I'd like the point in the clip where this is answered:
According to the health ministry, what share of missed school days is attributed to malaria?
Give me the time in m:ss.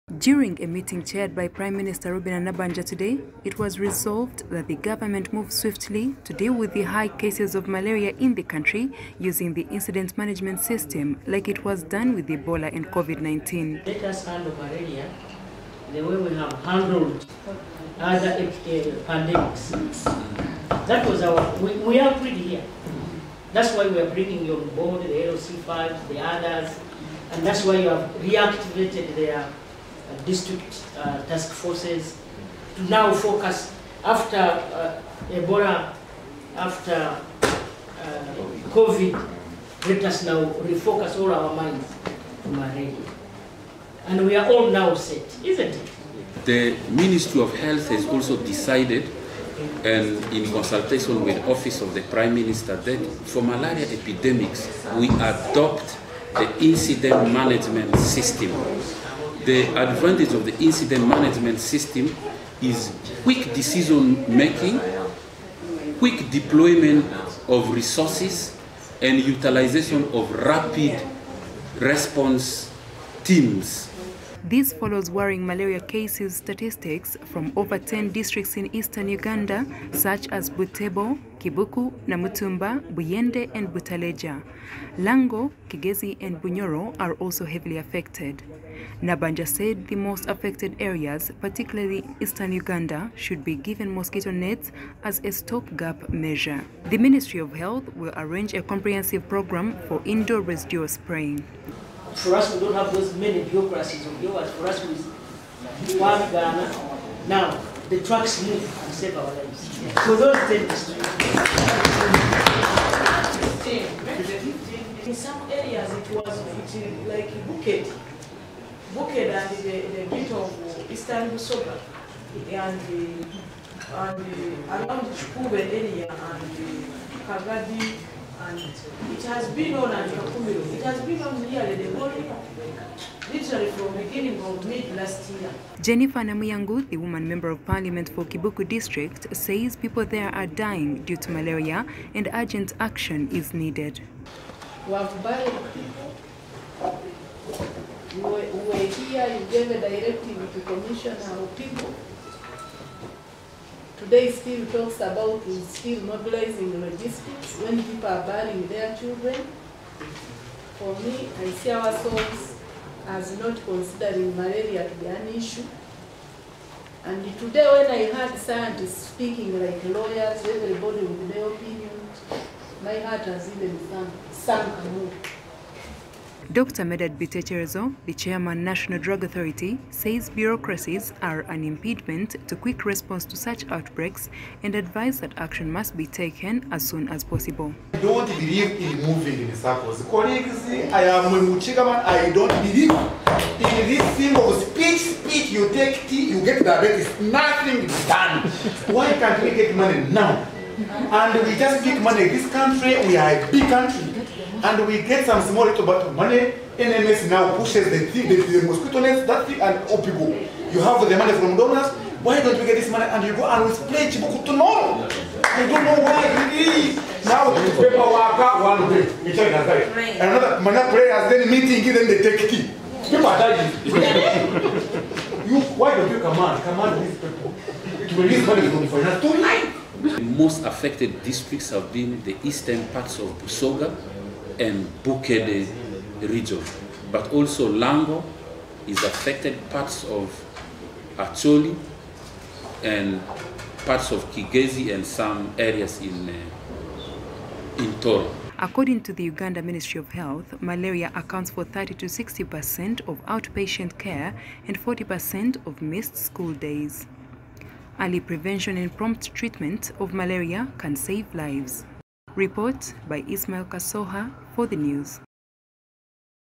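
4:14.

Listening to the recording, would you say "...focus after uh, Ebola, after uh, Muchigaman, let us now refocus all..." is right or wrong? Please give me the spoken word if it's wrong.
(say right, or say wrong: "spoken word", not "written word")
wrong: "COVID", not "Muchigaman".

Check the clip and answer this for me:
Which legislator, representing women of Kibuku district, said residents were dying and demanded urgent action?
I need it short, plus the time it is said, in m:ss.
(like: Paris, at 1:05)
Jennifer Namuyangu, at 2:15.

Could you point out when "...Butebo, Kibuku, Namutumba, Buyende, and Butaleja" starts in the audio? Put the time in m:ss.
1:20.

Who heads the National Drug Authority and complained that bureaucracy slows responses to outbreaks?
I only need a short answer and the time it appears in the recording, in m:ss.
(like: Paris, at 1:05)
Dr. Medard Bitekyerezo, at 2:56.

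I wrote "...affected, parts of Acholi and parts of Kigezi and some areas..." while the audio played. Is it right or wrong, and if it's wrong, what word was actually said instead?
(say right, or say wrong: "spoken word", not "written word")
right.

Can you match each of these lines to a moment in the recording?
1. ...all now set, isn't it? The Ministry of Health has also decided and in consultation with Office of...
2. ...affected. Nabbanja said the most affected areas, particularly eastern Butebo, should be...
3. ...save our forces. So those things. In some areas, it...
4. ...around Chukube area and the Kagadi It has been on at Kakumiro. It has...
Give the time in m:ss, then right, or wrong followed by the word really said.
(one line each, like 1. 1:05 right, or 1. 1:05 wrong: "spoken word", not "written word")
1. 0:44 right
2. 1:27 wrong: "Uganda", not "Butebo"
3. 1:48 wrong: "lives", not "forces"
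4. 2:04 right.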